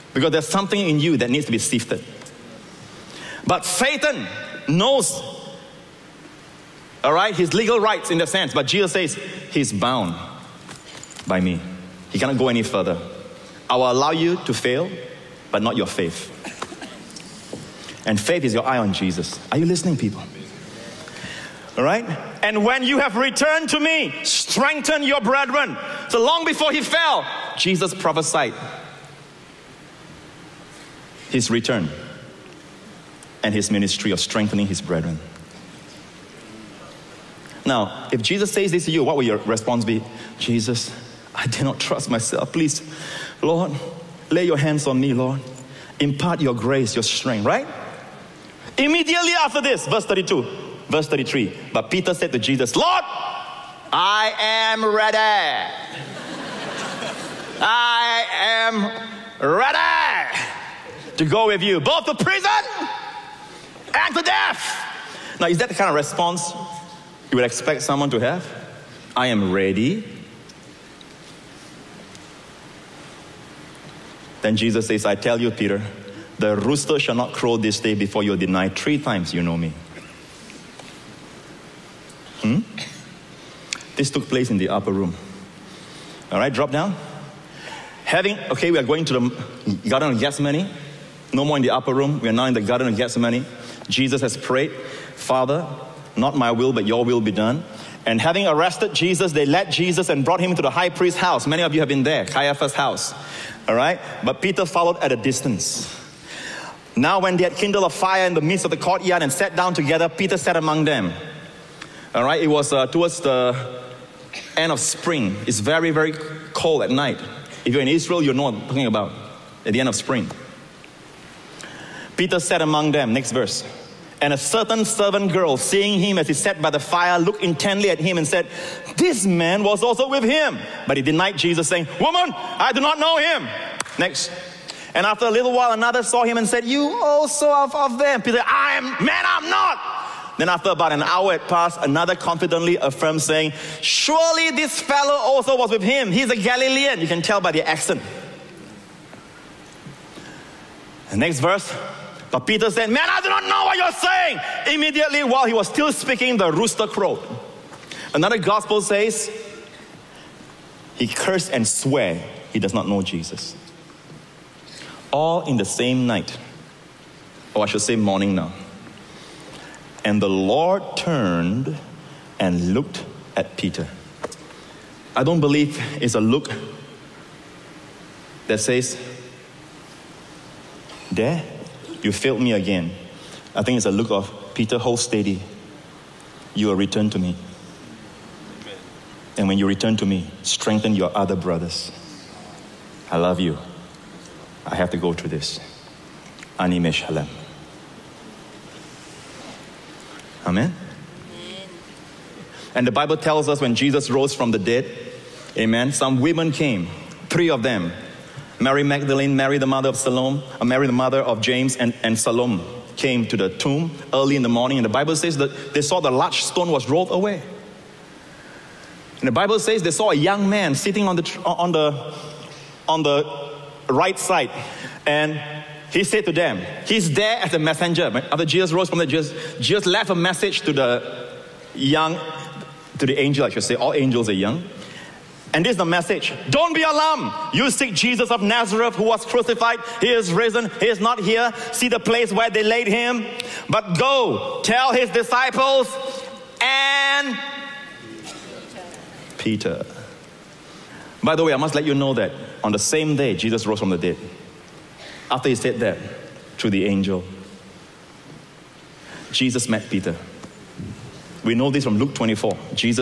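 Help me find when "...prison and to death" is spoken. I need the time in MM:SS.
01:02.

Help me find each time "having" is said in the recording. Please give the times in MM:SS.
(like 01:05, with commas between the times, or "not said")
01:28, 01:38.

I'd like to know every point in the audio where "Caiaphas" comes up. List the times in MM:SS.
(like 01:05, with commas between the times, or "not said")
01:42.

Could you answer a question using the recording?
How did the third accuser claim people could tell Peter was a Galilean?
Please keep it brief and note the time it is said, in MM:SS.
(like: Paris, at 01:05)
the accent, at 02:27.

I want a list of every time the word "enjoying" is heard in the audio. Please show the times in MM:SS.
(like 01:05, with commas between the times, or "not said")
not said.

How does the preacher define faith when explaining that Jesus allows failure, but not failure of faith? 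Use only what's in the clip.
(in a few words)
your eye on Jesus.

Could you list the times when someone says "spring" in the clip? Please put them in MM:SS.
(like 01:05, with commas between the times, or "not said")
01:54, 01:59.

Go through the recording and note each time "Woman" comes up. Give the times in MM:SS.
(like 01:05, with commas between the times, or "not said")
02:11.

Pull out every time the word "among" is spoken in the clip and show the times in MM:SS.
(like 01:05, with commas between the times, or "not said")
01:50, 02:02.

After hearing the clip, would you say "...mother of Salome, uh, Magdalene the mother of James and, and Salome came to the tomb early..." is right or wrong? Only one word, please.
wrong.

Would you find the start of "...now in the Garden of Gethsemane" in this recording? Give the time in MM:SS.
01:32.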